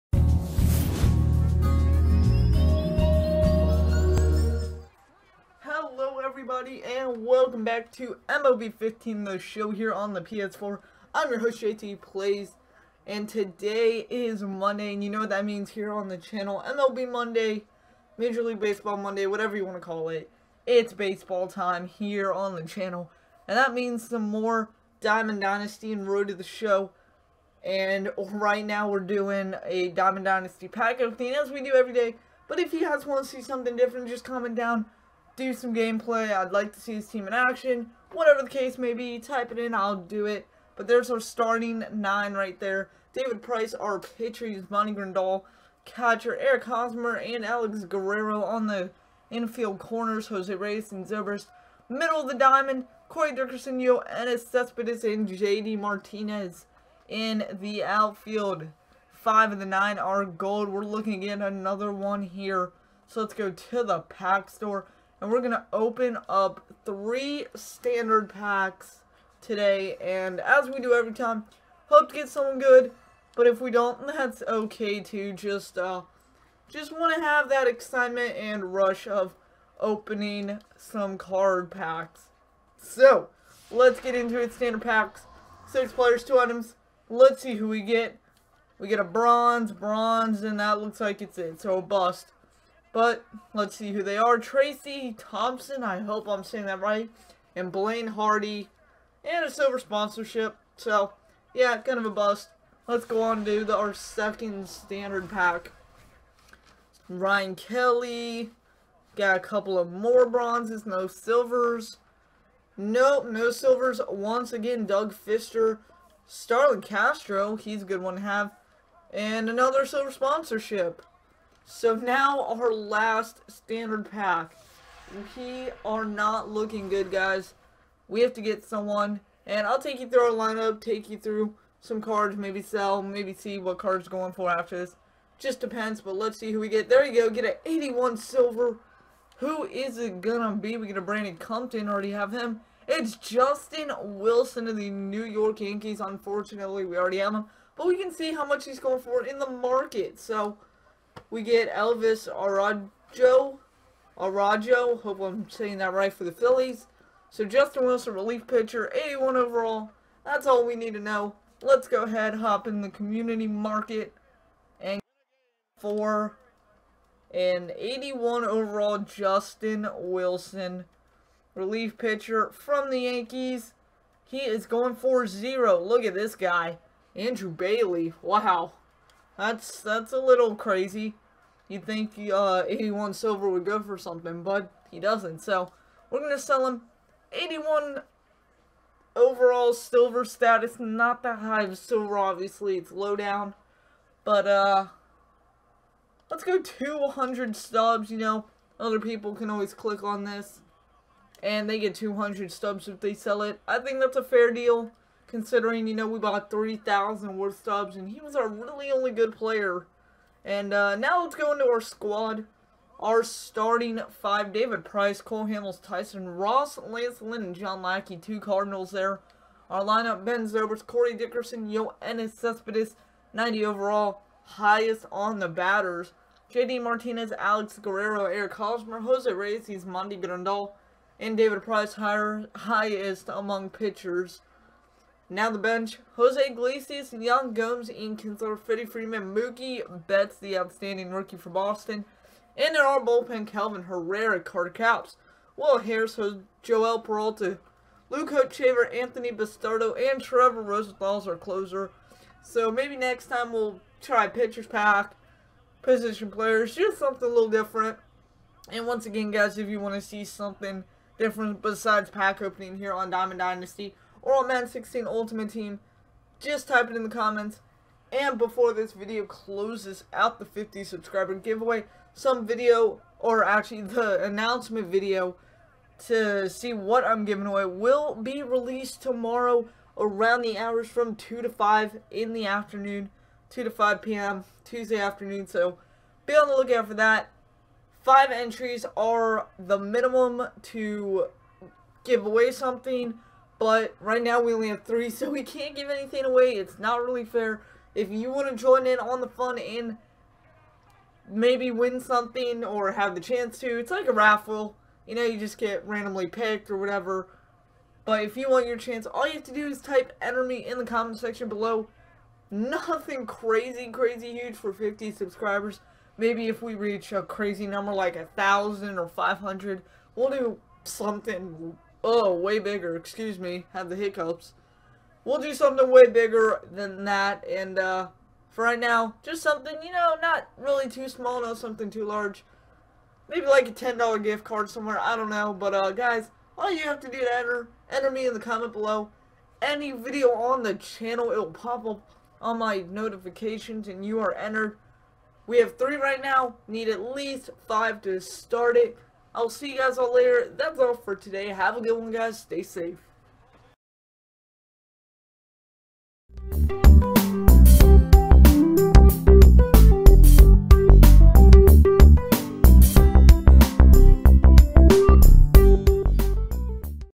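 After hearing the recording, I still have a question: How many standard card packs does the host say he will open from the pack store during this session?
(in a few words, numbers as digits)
3.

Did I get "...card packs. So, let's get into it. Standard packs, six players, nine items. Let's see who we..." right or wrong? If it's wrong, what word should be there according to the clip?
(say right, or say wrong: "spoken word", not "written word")
wrong: "two", not "nine".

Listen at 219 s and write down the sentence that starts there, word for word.
Our lineup, Ben Zobrist, Corey Dickerson, Yoenis Cespedes, 90 overall, highest on the batters.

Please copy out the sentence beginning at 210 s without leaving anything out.
And uh, now let's go into our squad.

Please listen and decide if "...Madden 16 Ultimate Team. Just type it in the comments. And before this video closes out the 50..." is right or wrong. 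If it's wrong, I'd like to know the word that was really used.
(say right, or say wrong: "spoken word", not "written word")
right.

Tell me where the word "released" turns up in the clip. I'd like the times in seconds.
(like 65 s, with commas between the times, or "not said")
278 s.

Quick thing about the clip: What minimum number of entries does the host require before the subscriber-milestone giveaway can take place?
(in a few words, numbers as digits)
5.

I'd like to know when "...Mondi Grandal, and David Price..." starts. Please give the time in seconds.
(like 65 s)
229 s.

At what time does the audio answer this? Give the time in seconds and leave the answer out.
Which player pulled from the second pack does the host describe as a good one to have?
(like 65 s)
116 s.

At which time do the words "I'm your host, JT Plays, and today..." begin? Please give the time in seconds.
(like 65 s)
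11 s.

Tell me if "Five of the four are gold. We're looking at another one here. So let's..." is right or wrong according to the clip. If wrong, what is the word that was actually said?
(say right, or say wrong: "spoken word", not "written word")
wrong: "nine", not "four".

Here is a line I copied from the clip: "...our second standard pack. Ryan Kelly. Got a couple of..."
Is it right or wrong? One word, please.
right.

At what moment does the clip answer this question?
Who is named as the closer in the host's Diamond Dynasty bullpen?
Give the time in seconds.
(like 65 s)
250 s.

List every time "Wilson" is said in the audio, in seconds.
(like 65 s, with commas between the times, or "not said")
144 s, 157 s, 169 s.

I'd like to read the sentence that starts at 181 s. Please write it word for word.
You'd think uh, 81 silver would go for something, but he doesn't.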